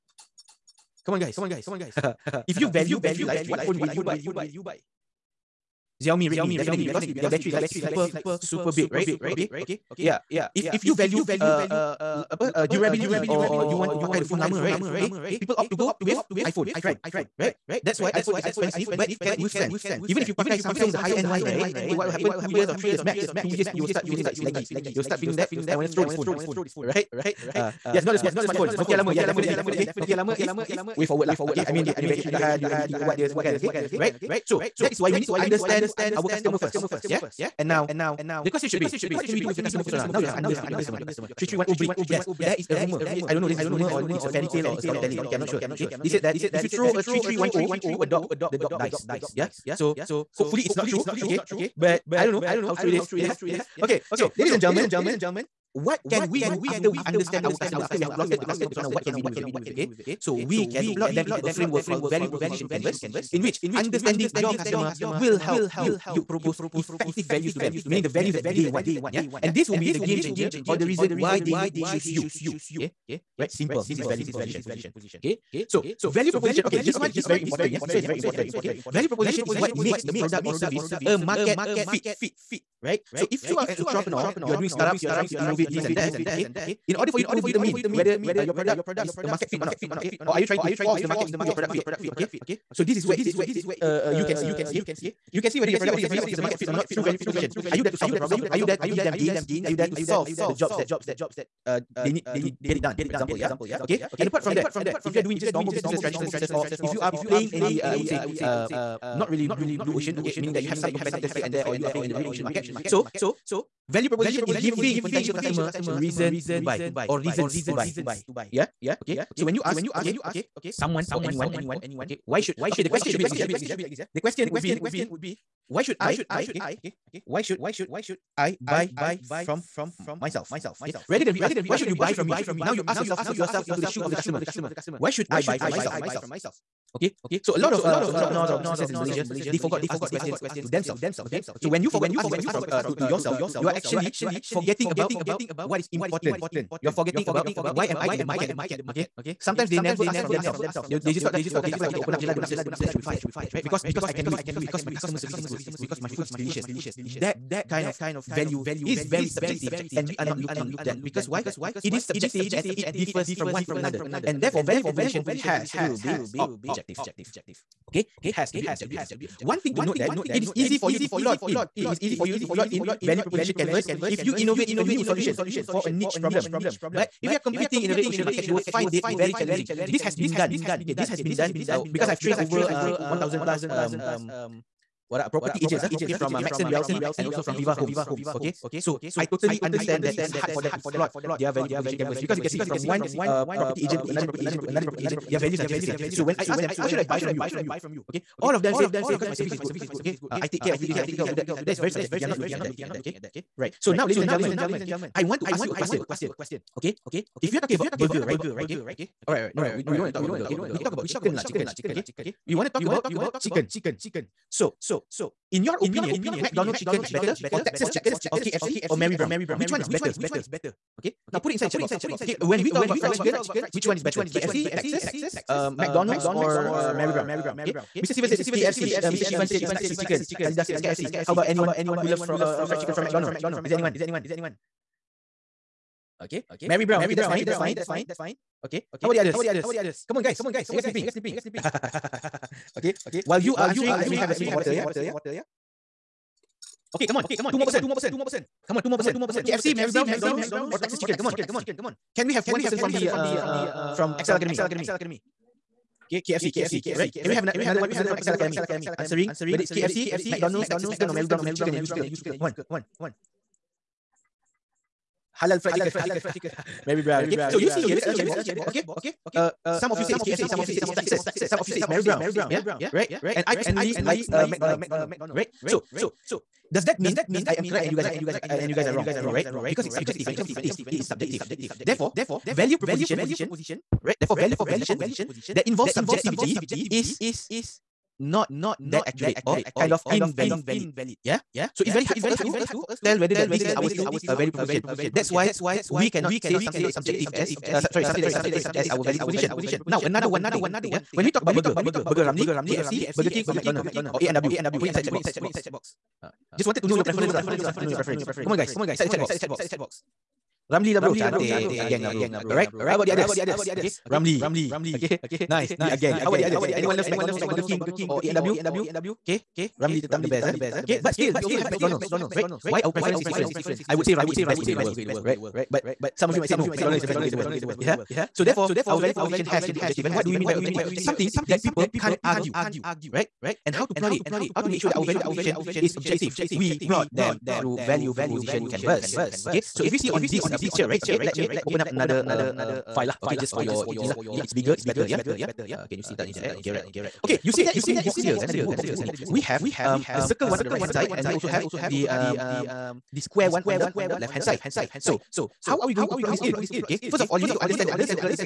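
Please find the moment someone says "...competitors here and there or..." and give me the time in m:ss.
1:50.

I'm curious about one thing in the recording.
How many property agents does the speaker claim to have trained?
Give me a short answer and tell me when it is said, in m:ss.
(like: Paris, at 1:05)
1000 plus, at 3:03.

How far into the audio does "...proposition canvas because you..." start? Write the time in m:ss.
3:11.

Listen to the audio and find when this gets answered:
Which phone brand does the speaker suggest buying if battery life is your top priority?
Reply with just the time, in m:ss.
0:06.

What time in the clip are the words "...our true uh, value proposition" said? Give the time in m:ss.
4:53.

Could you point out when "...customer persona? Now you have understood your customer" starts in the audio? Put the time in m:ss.
0:39.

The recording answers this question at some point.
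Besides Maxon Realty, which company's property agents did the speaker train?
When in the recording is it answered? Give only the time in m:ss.
3:07.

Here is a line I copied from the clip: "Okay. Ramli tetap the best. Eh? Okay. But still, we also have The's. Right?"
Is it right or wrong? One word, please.
wrong.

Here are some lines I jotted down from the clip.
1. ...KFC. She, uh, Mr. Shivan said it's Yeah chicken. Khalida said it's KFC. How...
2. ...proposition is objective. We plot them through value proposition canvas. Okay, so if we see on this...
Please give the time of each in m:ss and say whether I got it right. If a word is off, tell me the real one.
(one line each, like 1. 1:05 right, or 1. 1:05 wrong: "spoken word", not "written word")
1. 3:48 wrong: "Texas", not "Yeah"
2. 5:35 right.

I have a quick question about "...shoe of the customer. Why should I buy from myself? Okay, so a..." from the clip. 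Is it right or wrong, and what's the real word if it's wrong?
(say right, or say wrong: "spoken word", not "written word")
right.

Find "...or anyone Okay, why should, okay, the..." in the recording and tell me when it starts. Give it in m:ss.
2:01.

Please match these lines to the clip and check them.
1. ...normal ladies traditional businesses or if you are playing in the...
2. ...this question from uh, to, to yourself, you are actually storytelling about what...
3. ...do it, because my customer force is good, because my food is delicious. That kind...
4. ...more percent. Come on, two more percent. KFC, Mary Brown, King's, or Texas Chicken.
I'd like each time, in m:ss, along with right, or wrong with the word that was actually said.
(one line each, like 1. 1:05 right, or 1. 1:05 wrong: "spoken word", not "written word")
1. 1:45 wrong: "businesses", not "ladies"
2. 2:22 wrong: "forgetting", not "storytelling"
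3. 2:34 wrong: "service", not "force"
4. 4:07 wrong: "McDonald", not "King".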